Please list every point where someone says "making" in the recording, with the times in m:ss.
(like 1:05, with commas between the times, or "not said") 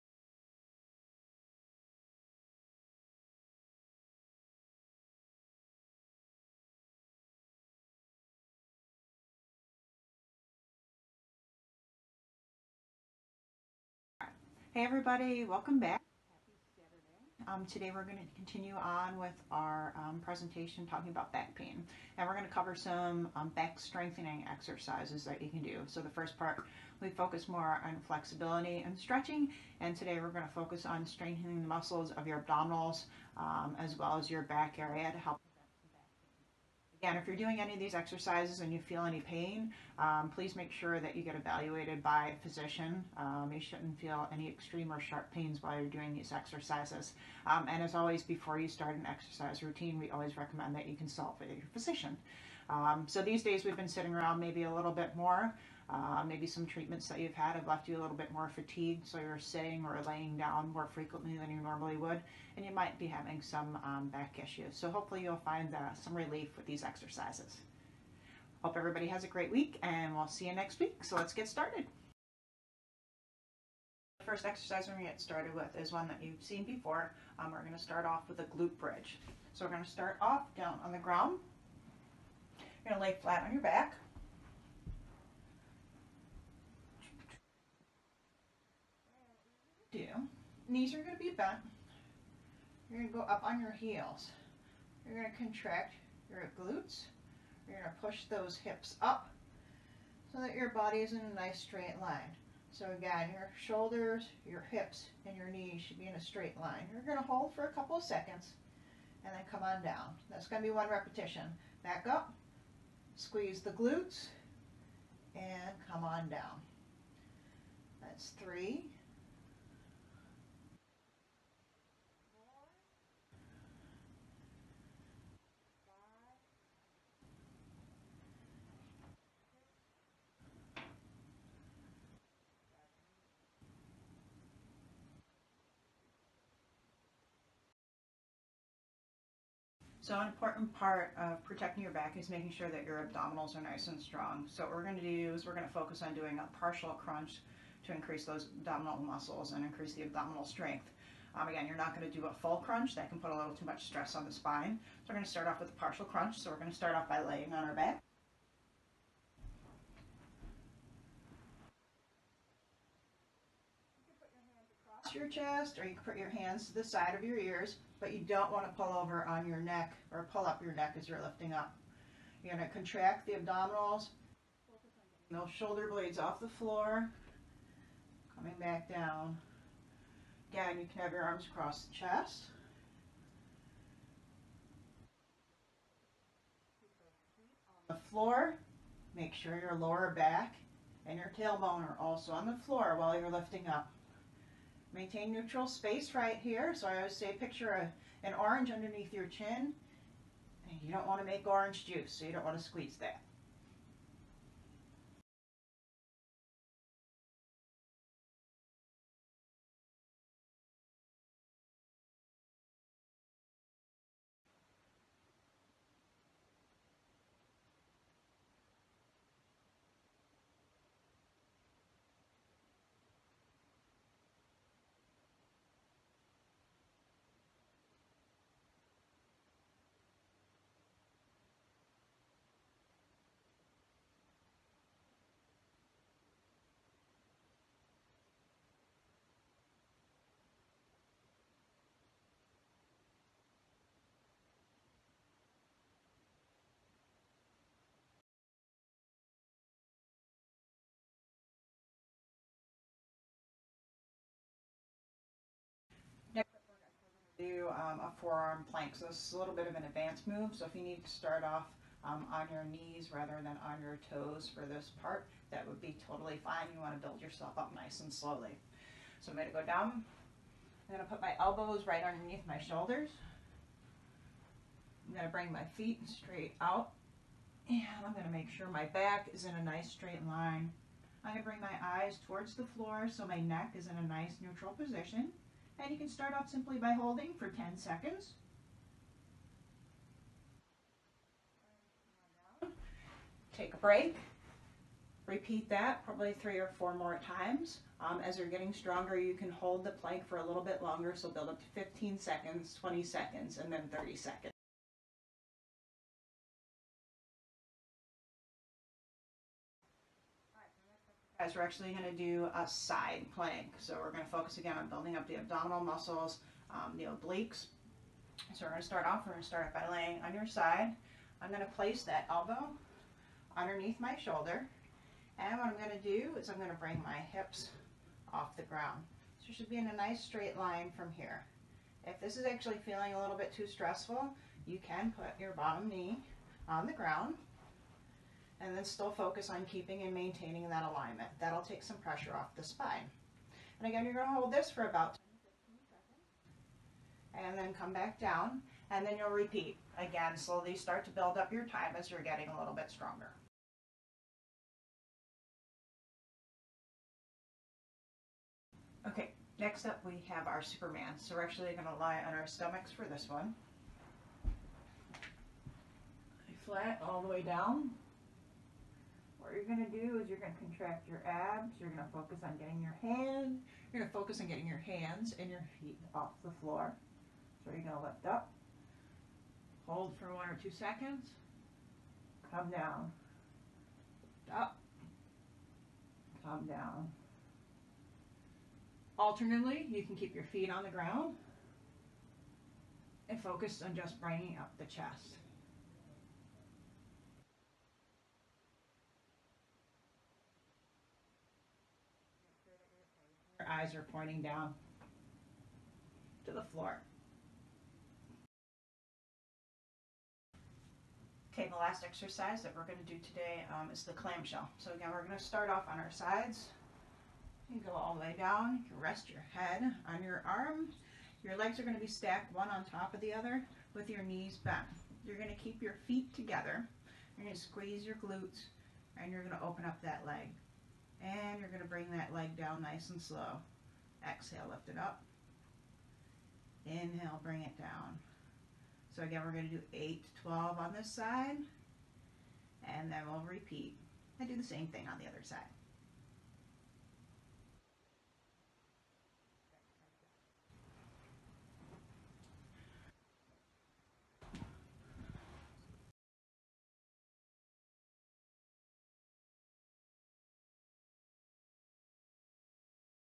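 2:22.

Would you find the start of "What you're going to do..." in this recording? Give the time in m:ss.
6:09.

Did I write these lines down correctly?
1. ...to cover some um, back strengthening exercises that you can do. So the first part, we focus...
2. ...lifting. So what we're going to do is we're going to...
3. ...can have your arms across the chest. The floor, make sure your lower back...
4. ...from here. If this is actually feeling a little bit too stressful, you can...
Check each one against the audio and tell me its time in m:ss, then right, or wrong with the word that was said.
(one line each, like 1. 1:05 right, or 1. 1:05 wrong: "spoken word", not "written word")
1. 0:22 right
2. 2:24 wrong: "strong", not "lifting"
3. 3:00 right
4. 5:30 right.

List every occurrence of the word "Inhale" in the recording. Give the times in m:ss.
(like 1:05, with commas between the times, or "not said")
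7:16.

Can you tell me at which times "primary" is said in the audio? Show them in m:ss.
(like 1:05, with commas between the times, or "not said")
not said.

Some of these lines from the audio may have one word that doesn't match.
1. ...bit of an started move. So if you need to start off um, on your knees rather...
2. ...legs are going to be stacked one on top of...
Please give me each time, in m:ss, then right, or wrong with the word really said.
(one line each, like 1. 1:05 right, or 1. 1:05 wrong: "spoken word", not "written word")
1. 4:19 wrong: "advanced", not "started"
2. 7:01 right.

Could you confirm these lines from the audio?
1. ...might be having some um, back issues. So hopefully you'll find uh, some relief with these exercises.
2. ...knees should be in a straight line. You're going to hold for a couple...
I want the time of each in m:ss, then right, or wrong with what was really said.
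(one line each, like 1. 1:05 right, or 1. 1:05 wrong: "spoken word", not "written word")
1. 1:02 right
2. 1:45 right.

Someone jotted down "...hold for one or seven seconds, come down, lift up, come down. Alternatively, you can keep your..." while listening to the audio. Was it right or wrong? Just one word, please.
wrong.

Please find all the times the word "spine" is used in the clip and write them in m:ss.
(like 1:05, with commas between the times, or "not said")
2:34, 5:42.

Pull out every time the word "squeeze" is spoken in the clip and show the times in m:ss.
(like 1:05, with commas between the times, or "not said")
1:53, 3:22, 7:07.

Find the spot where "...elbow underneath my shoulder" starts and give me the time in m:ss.
5:22.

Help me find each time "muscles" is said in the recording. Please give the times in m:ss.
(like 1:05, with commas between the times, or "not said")
0:31, 2:28, 5:15.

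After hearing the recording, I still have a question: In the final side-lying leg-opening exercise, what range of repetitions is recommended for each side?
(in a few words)
8 to 12.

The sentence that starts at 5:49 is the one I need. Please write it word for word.
Again, slowly start to build up your time as you're getting a little bit stronger.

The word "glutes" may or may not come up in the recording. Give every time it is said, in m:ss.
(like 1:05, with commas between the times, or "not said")
1:18, 1:36, 1:53, 7:08.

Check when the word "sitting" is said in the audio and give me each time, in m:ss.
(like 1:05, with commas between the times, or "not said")
0:53, 0:59.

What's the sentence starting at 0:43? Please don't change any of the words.
Um, you shouldn't feel any extreme or sharp pains while you're doing these exercises.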